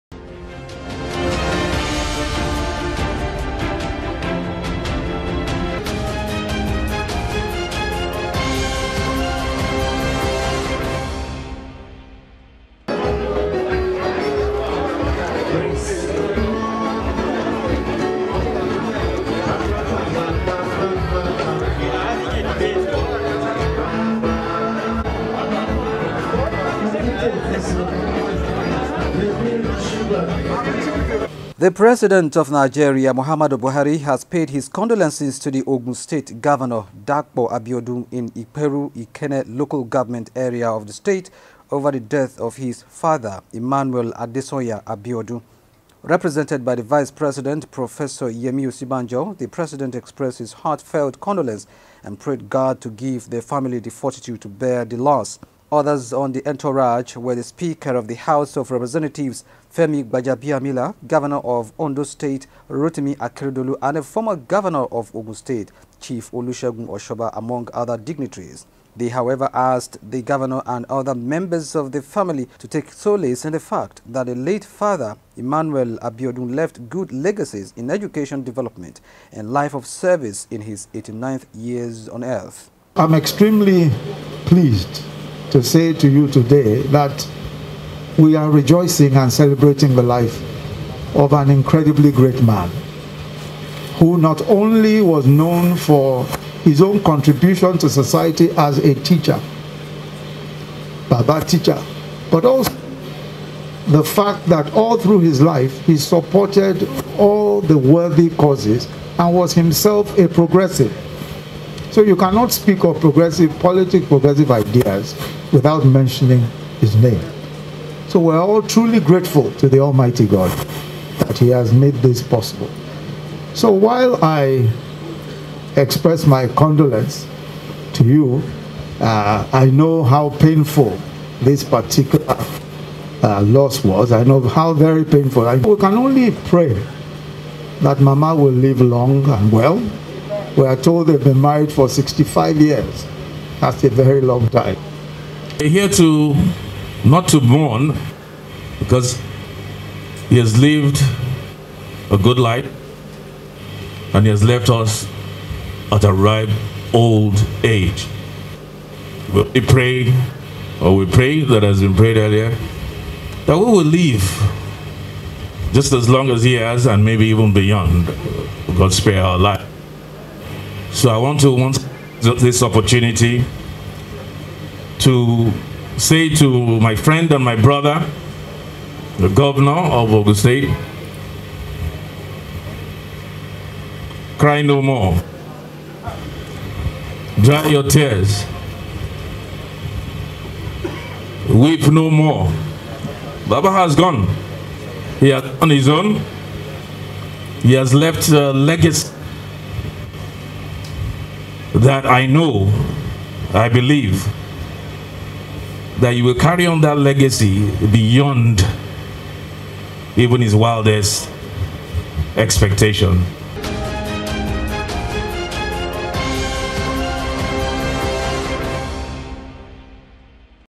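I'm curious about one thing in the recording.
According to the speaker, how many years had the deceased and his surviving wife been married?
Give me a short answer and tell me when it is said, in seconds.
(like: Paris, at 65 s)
65, at 141 s.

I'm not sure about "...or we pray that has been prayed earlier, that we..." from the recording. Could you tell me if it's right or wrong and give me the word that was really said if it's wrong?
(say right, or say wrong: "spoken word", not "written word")
right.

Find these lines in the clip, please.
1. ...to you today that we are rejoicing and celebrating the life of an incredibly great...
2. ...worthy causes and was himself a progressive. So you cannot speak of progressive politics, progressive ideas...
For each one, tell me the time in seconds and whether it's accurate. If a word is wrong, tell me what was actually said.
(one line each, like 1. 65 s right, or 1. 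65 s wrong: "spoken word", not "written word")
1. 85 s right
2. 107 s right.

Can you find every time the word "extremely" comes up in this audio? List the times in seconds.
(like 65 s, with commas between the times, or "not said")
83 s.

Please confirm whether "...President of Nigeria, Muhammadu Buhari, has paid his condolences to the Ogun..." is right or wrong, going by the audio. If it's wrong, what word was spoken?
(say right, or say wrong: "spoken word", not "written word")
right.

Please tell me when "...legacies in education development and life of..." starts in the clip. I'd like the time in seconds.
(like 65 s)
77 s.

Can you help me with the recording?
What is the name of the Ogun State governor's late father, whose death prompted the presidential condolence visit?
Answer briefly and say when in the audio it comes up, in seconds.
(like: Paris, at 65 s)
Emmanuel Adesanya Abiodun, at 43 s.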